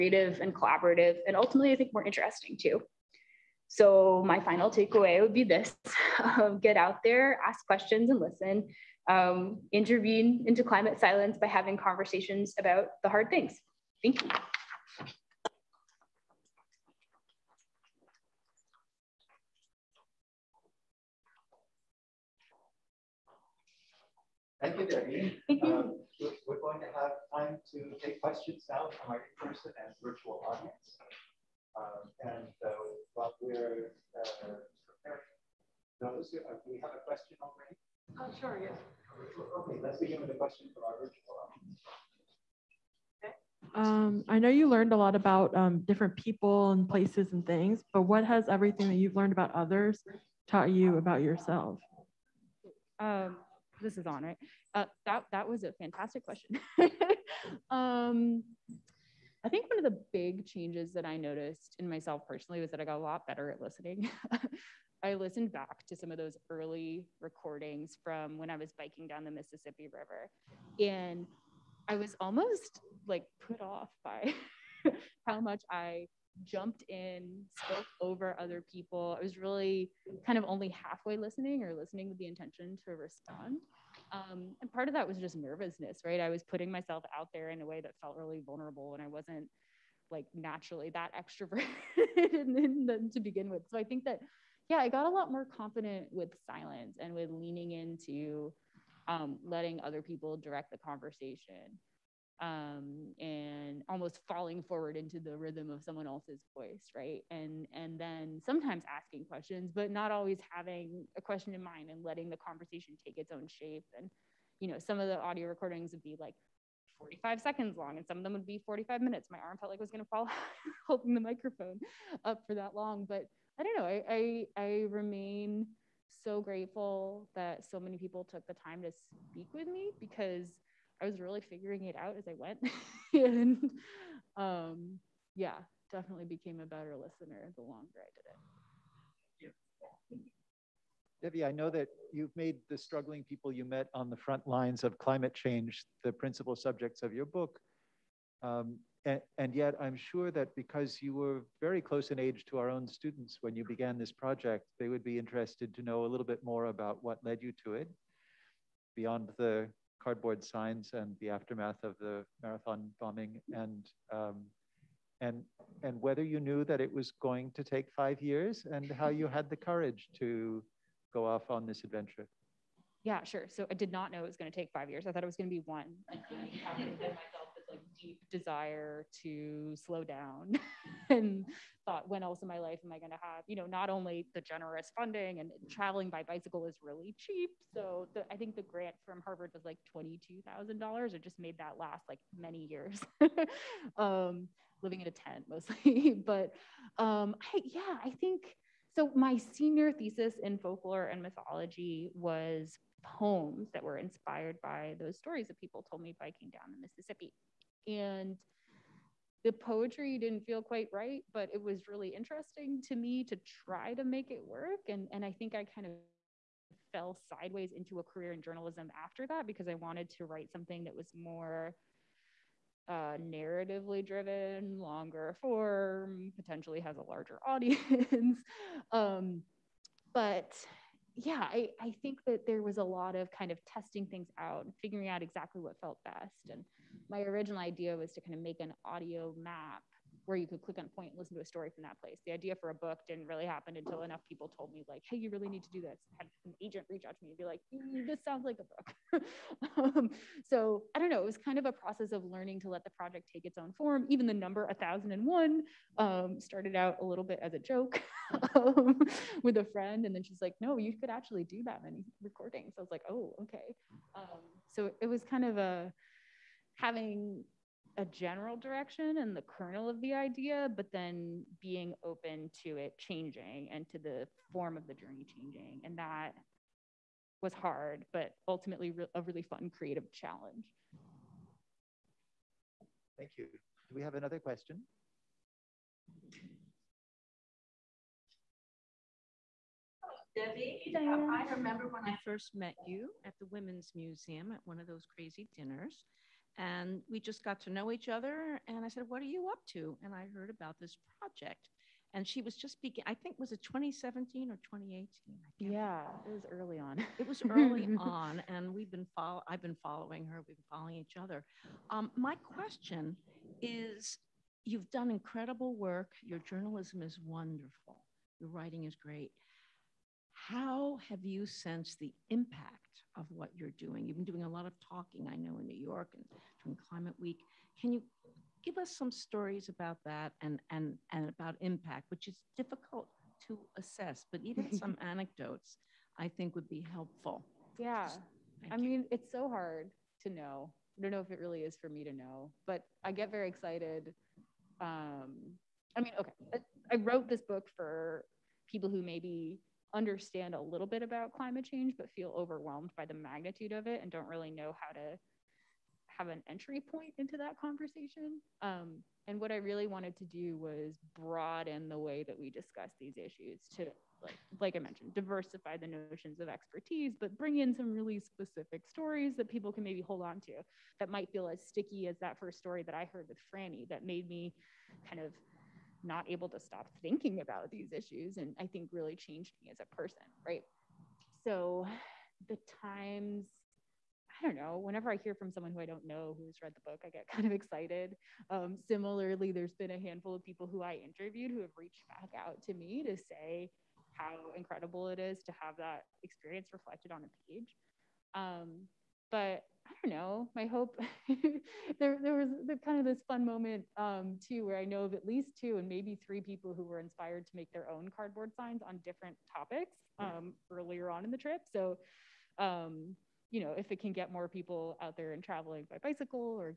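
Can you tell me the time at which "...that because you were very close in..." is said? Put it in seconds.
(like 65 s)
150 s.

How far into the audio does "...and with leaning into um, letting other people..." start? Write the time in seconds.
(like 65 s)
97 s.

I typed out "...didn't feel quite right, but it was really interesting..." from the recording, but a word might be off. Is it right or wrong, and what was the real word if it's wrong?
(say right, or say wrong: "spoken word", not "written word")
right.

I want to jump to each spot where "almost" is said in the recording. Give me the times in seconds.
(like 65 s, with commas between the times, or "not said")
72 s, 103 s.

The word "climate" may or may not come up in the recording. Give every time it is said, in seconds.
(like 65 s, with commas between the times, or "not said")
10 s, 144 s, 326 s, 351 s.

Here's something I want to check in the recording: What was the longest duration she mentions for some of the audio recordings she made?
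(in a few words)
45 minutes.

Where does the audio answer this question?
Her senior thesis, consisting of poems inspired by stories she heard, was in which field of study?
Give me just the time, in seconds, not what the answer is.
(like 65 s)
200 s.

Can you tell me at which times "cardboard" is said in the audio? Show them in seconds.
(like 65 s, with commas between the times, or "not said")
160 s, 408 s.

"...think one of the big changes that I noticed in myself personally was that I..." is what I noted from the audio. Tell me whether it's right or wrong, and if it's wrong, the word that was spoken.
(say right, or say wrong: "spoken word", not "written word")
right.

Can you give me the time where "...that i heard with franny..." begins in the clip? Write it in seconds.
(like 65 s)
372 s.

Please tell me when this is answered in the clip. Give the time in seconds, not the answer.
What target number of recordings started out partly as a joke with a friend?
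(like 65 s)
254 s.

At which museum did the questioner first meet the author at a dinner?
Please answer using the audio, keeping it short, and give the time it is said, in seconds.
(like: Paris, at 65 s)
Women's Museum, at 293 s.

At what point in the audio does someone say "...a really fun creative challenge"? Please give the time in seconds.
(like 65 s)
279 s.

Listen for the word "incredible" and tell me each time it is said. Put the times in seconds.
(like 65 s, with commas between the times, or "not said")
315 s, 394 s.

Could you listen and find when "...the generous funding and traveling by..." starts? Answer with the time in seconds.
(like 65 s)
184 s.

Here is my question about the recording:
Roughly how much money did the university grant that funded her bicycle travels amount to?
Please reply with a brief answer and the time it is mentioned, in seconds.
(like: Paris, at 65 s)
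$22000, at 189 s.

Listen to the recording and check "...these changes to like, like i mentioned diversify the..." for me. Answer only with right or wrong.
wrong.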